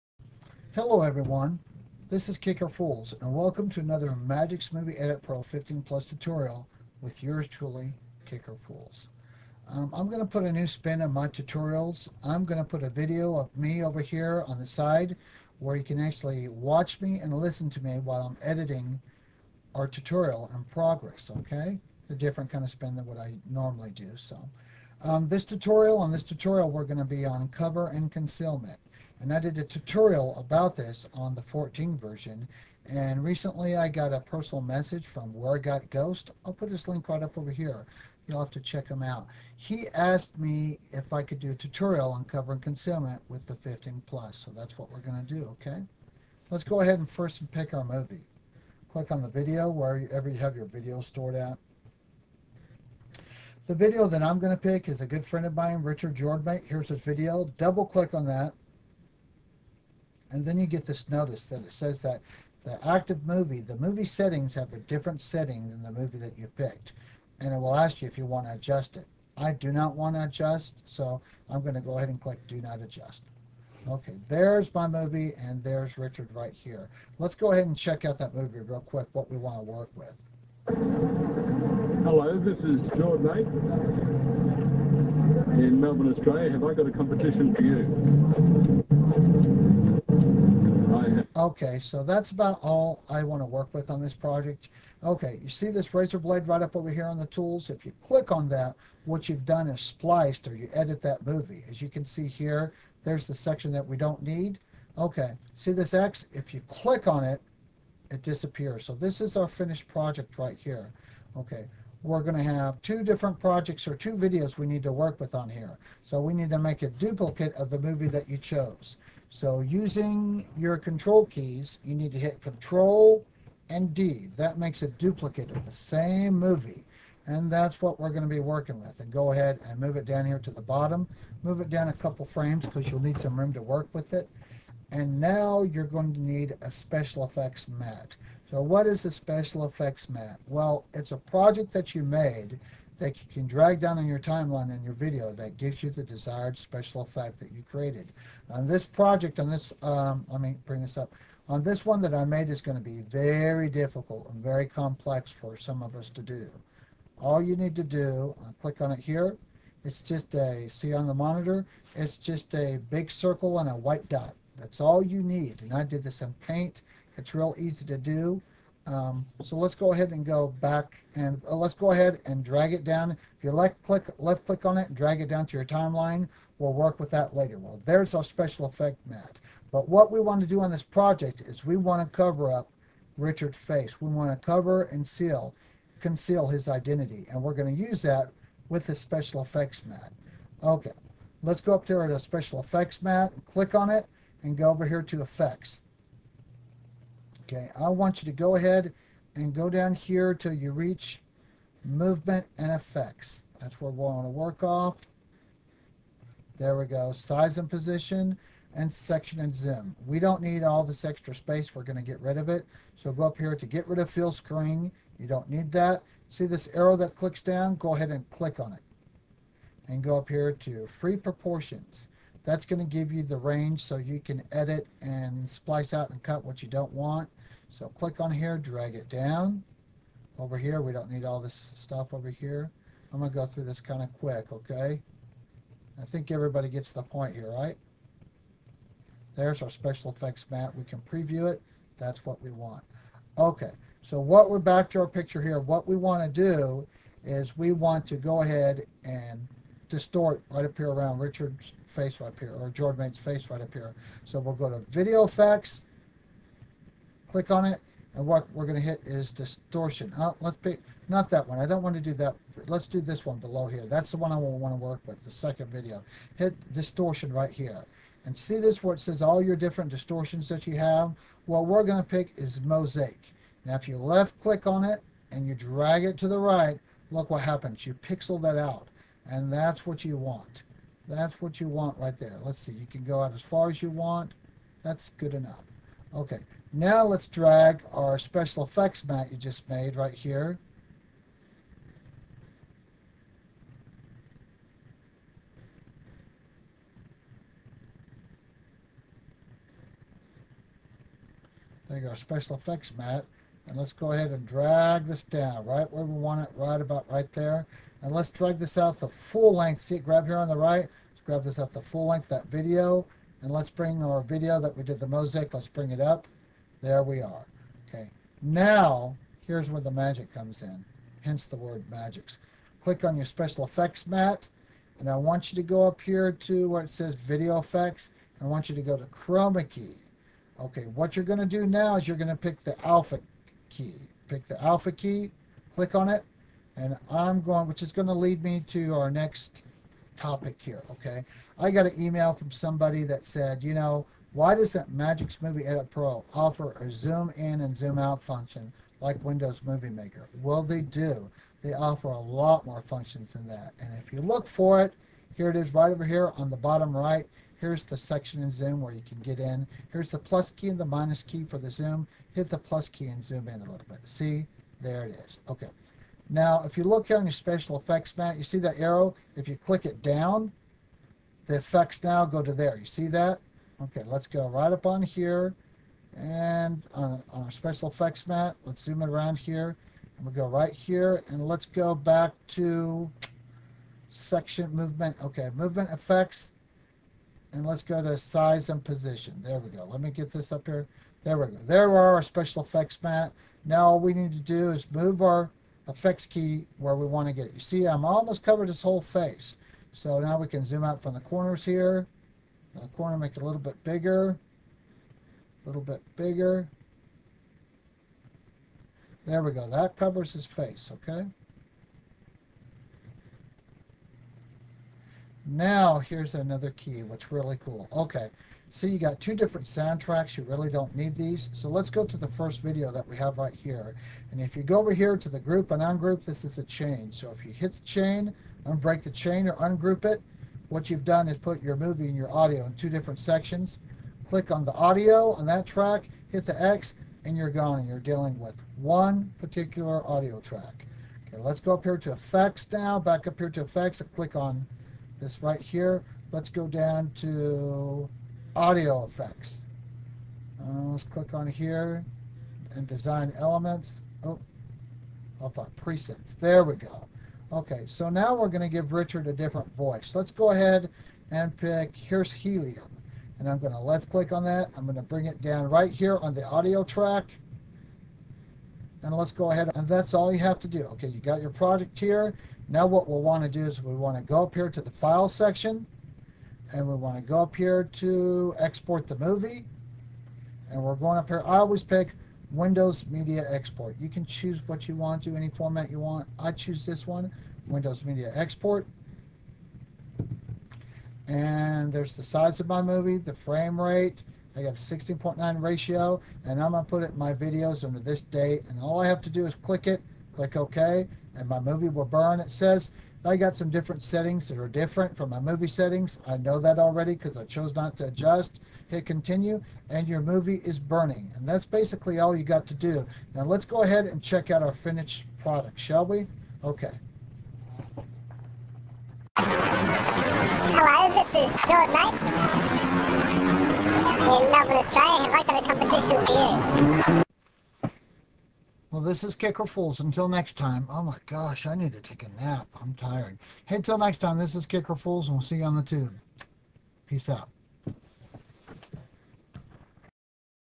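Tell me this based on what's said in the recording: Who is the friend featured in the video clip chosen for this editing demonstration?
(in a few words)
Richard Jordan.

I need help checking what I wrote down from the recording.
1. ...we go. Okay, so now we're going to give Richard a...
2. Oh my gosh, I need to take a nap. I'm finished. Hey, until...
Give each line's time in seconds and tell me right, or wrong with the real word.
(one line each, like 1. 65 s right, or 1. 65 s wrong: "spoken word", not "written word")
1. 456 s right
2. 530 s wrong: "tired", not "finished".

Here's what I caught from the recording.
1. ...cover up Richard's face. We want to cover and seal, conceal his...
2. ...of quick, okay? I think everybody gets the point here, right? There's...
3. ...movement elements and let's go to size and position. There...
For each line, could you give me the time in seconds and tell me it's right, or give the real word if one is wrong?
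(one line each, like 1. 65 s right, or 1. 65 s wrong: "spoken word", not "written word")
1. 182 s right
2. 234 s right
3. 385 s wrong: "effects", not "elements".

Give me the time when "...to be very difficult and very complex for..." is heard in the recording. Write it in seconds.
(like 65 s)
152 s.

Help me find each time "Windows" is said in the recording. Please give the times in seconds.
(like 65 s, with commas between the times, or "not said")
349 s, 482 s, 487 s.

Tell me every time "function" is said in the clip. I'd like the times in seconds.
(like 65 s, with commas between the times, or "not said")
348 s, 352 s.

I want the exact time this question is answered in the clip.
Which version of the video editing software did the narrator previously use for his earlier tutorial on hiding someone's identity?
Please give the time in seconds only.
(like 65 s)
31 s.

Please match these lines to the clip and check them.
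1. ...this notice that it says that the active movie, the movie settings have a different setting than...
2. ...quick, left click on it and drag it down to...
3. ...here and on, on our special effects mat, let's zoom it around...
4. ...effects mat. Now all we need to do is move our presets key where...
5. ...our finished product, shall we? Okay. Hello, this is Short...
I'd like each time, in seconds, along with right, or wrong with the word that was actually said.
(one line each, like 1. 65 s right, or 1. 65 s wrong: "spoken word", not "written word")
1. 60 s right
2. 173 s wrong: "click", not "quick"
3. 375 s right
4. 392 s wrong: "effects", not "presets"
5. 514 s right.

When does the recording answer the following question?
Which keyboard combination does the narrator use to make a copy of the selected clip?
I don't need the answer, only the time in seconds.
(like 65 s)
122 s.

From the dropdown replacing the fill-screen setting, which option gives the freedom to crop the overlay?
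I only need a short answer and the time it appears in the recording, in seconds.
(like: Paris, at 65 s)
Free proportions, at 220 s.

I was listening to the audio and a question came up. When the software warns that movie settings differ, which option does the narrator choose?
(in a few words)
Do Not Adjust.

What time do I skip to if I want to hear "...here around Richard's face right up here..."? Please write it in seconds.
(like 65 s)
250 s.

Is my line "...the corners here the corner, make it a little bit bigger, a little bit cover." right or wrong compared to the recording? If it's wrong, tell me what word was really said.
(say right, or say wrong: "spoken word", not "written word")
wrong: "bigger", not "cover".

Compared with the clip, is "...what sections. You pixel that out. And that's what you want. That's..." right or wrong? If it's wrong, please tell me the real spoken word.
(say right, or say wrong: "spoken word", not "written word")
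wrong: "happens", not "sections".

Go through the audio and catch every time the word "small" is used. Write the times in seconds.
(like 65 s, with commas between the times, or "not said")
not said.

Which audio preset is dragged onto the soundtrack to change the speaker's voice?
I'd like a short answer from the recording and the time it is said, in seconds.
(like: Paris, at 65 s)
Helium, at 462 s.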